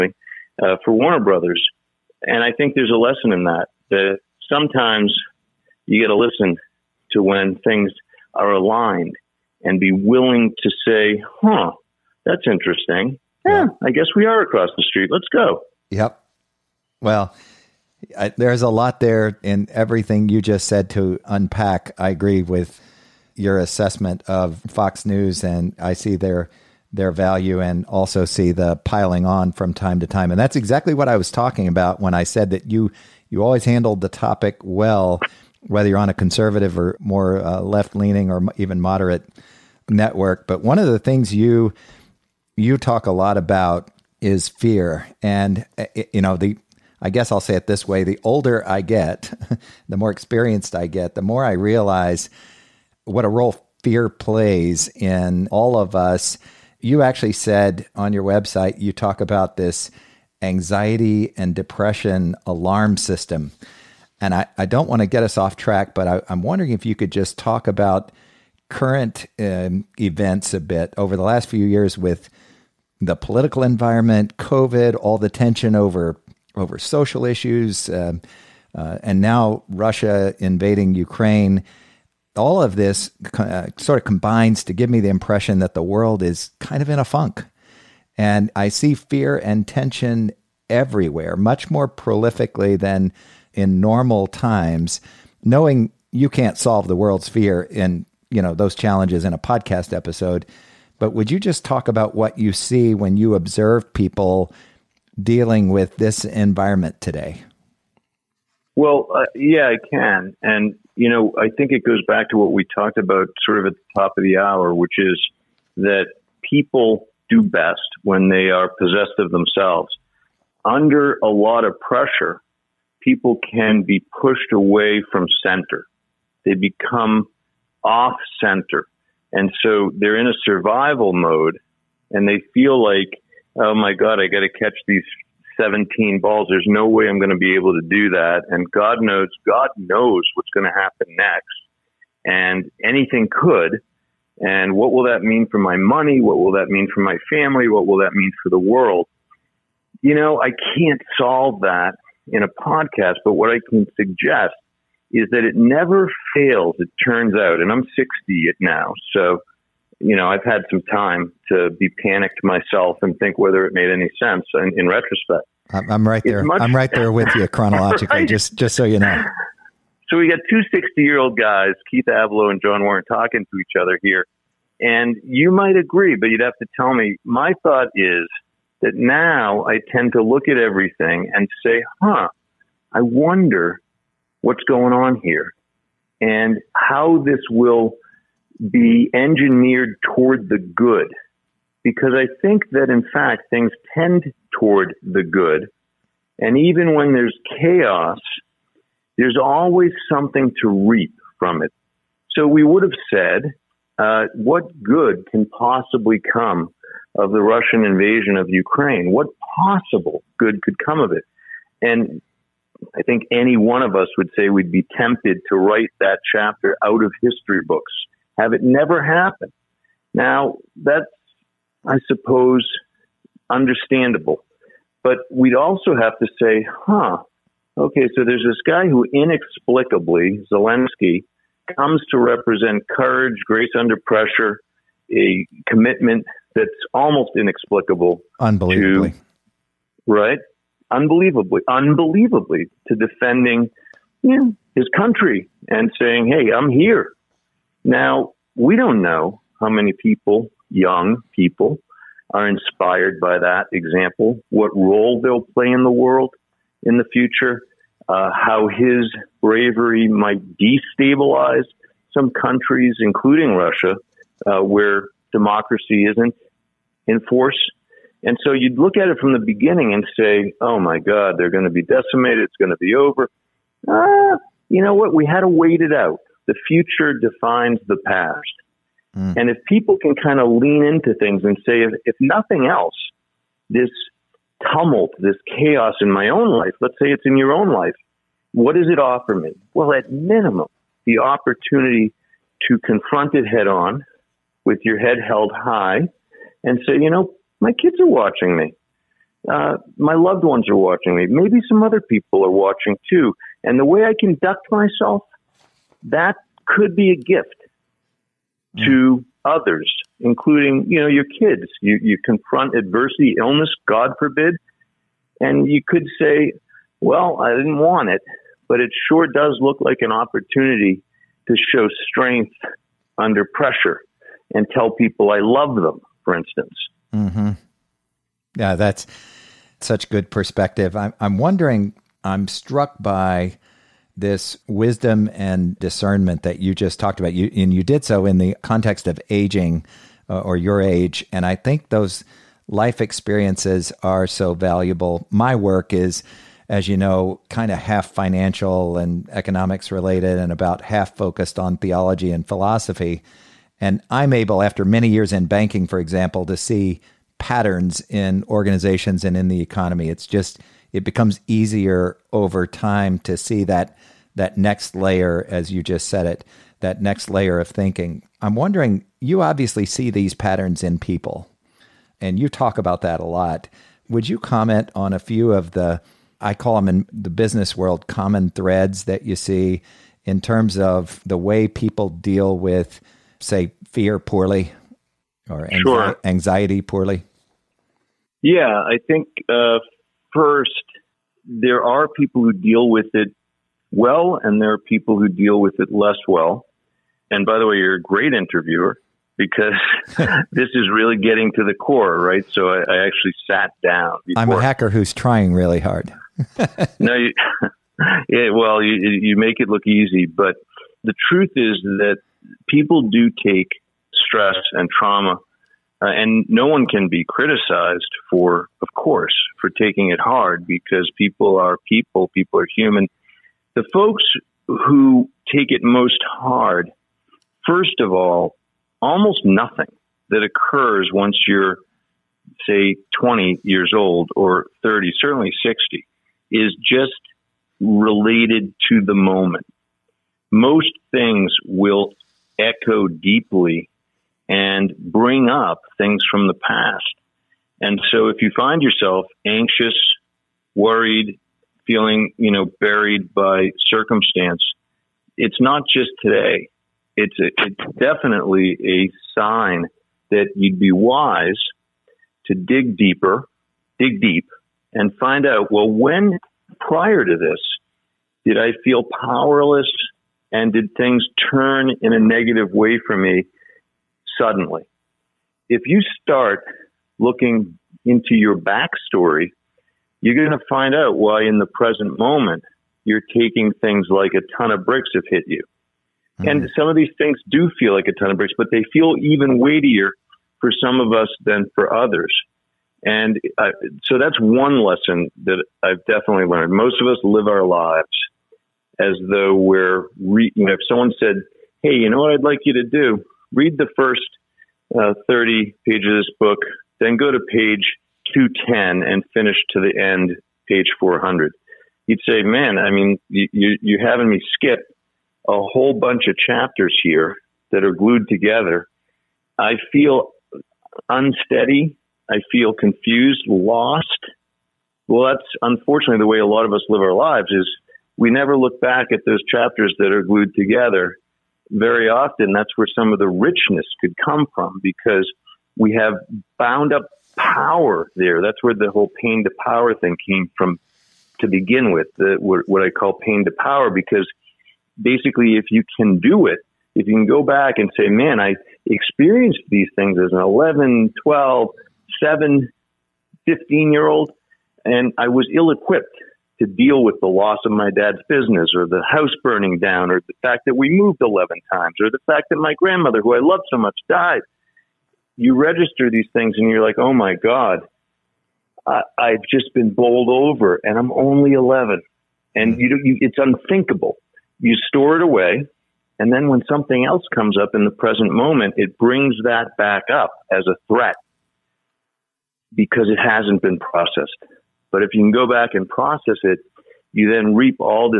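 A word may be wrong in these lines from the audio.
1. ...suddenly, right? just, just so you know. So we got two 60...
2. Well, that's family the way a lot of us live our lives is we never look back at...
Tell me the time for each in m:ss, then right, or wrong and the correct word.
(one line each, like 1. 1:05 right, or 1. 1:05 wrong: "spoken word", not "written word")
1. 2:47 wrong: "chronologically", not "suddenly"
2. 8:45 wrong: "unfortunately", not "family".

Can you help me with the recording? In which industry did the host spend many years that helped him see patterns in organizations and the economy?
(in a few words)
banking.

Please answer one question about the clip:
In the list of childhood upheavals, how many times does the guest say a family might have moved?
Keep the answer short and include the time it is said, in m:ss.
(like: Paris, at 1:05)
11, at 9:21.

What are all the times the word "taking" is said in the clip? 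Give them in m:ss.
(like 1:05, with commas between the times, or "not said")
6:59, 8:03.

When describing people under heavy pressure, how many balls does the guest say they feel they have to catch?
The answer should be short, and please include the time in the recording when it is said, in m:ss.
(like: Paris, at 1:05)
17, at 2:15.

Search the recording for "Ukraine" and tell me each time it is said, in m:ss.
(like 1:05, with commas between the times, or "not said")
1:20, 3:28.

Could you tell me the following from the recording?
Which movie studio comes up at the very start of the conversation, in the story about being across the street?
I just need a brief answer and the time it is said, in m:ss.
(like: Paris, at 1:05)
Warner Brothers, at 0:00.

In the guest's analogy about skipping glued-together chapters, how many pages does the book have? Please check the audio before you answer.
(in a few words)
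400.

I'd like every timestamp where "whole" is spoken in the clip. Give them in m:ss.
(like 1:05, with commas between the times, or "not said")
8:35, 8:58.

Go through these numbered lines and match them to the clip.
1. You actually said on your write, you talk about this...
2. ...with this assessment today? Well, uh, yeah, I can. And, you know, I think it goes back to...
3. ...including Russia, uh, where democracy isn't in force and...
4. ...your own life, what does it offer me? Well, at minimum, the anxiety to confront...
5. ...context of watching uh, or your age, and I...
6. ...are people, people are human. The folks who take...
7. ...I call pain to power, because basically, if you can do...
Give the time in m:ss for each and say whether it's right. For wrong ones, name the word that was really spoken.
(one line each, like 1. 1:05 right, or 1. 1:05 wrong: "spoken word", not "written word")
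1. 0:56 wrong: "website", not "write"
2. 1:45 wrong: "environment", not "assessment"
3. 4:23 right
4. 4:47 wrong: "opportunity", not "anxiety"
5. 5:38 wrong: "aging", not "watching"
6. 7:01 right
7. 9:02 right.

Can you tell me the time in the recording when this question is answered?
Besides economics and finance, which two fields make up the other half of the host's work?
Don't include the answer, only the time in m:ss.
5:51.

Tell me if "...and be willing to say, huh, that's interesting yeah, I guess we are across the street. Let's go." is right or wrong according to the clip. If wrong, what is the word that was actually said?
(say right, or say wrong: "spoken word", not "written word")
right.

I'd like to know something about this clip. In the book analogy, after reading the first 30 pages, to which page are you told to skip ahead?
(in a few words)
210.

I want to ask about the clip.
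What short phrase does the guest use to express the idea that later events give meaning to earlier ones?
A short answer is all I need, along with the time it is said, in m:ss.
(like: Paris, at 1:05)
The future defines the past, at 4:36.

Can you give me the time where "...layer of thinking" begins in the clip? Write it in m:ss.
6:07.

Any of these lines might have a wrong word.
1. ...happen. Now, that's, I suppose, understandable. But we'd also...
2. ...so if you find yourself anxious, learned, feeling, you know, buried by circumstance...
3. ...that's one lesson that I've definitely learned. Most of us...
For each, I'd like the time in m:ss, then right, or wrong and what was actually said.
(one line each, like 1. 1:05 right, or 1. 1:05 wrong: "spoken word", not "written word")
1. 3:39 right
2. 7:28 wrong: "worried", not "learned"
3. 8:14 right.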